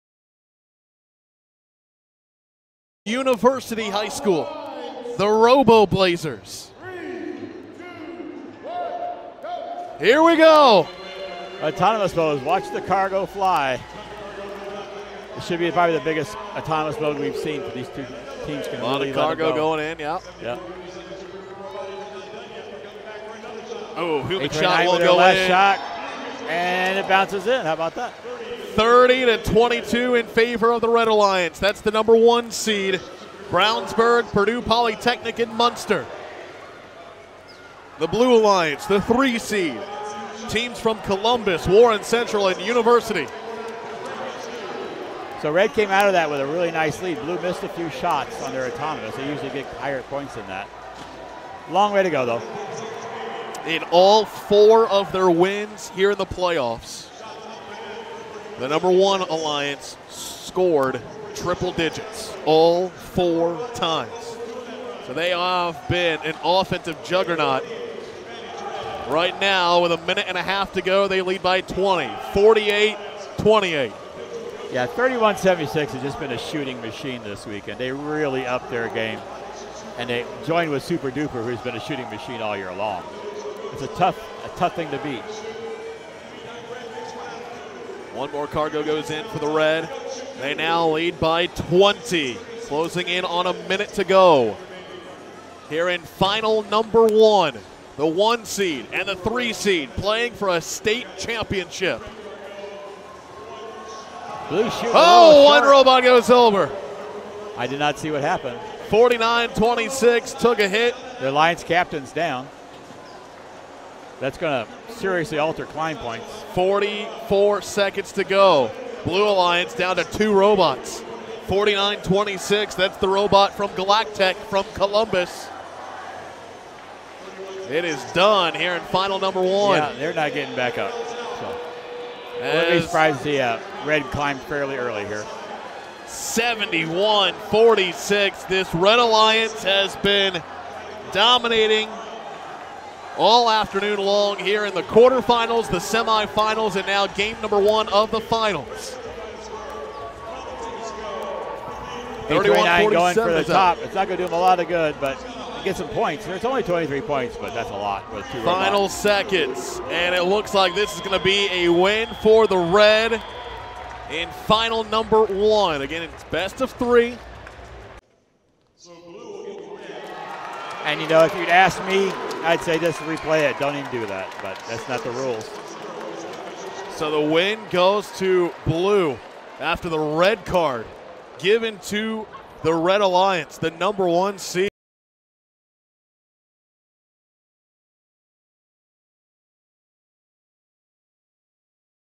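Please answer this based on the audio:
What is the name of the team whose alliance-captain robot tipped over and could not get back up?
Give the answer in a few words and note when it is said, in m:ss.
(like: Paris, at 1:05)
Galactech, at 2:03.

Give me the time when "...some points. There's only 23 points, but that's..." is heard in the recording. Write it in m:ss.
2:35.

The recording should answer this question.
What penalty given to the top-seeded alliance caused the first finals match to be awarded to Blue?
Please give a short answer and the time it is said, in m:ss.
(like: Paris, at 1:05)
Red card, at 2:59.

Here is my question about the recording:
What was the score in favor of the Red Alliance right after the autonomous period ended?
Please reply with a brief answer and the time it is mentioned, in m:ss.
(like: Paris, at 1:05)
30 to 22, at 0:28.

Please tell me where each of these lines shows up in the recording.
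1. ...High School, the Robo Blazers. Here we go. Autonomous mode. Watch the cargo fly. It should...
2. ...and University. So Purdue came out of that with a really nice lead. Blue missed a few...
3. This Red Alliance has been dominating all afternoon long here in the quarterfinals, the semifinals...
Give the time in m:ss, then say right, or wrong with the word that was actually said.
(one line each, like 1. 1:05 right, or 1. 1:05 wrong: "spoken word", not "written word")
1. 0:03 right
2. 0:42 wrong: "Red", not "Purdue"
3. 2:18 right.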